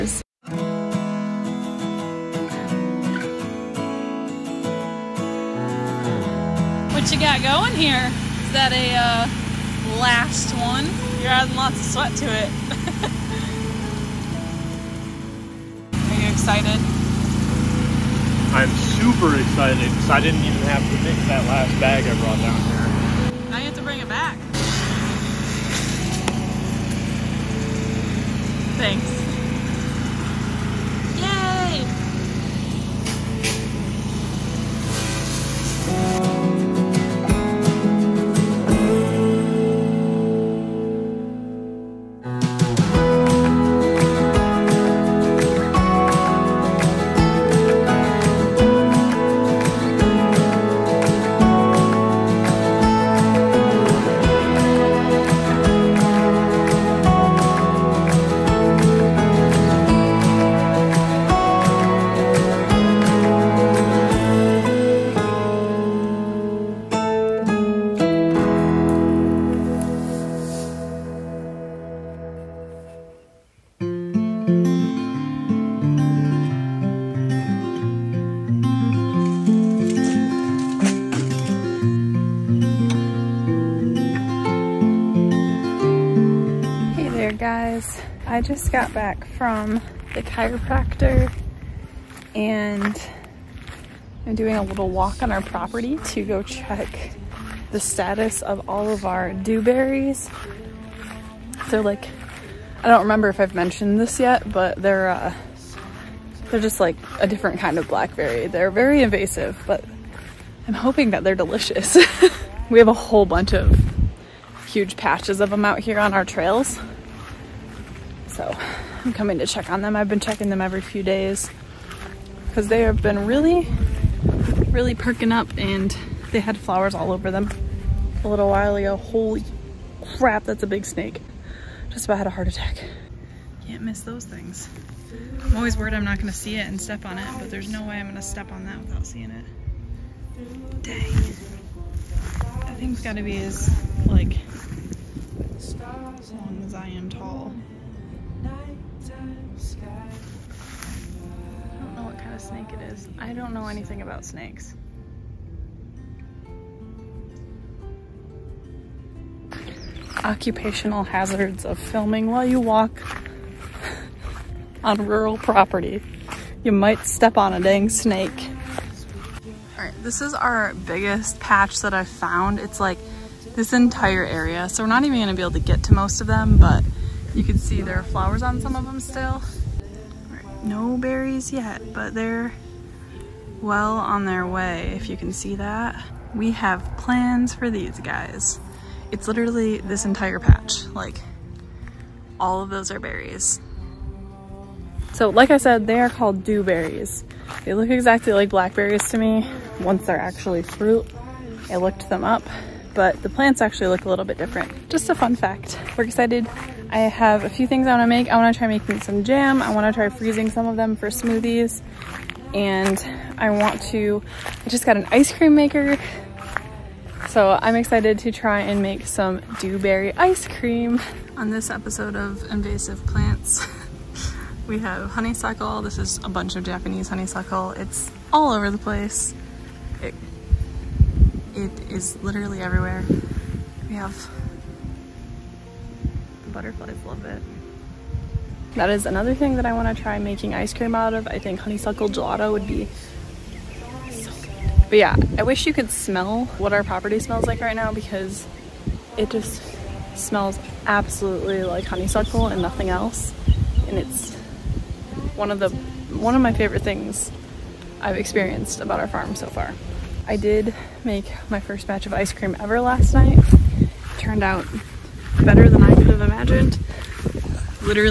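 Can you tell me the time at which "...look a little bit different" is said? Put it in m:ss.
3:23.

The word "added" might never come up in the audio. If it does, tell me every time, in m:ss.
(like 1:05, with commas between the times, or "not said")
not said.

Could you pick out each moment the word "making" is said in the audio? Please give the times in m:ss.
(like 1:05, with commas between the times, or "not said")
3:28, 4:00.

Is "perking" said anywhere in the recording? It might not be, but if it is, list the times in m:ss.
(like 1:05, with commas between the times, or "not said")
2:04.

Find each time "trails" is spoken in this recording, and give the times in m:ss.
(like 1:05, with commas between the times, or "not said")
1:56.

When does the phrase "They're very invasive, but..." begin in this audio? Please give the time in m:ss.
1:48.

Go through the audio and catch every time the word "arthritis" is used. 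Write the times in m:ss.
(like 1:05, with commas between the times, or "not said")
not said.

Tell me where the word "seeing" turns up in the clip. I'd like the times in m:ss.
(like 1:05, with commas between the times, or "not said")
2:19.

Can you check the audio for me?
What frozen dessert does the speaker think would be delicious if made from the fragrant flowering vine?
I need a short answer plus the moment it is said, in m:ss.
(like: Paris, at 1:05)
Honeysuckle gelato, at 4:01.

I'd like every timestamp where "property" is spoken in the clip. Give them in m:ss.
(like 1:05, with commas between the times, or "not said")
1:35, 2:45, 4:06.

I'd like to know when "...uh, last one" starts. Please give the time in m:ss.
0:08.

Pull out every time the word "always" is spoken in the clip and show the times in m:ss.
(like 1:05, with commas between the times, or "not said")
2:15.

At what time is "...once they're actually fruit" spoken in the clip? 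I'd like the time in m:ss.
3:19.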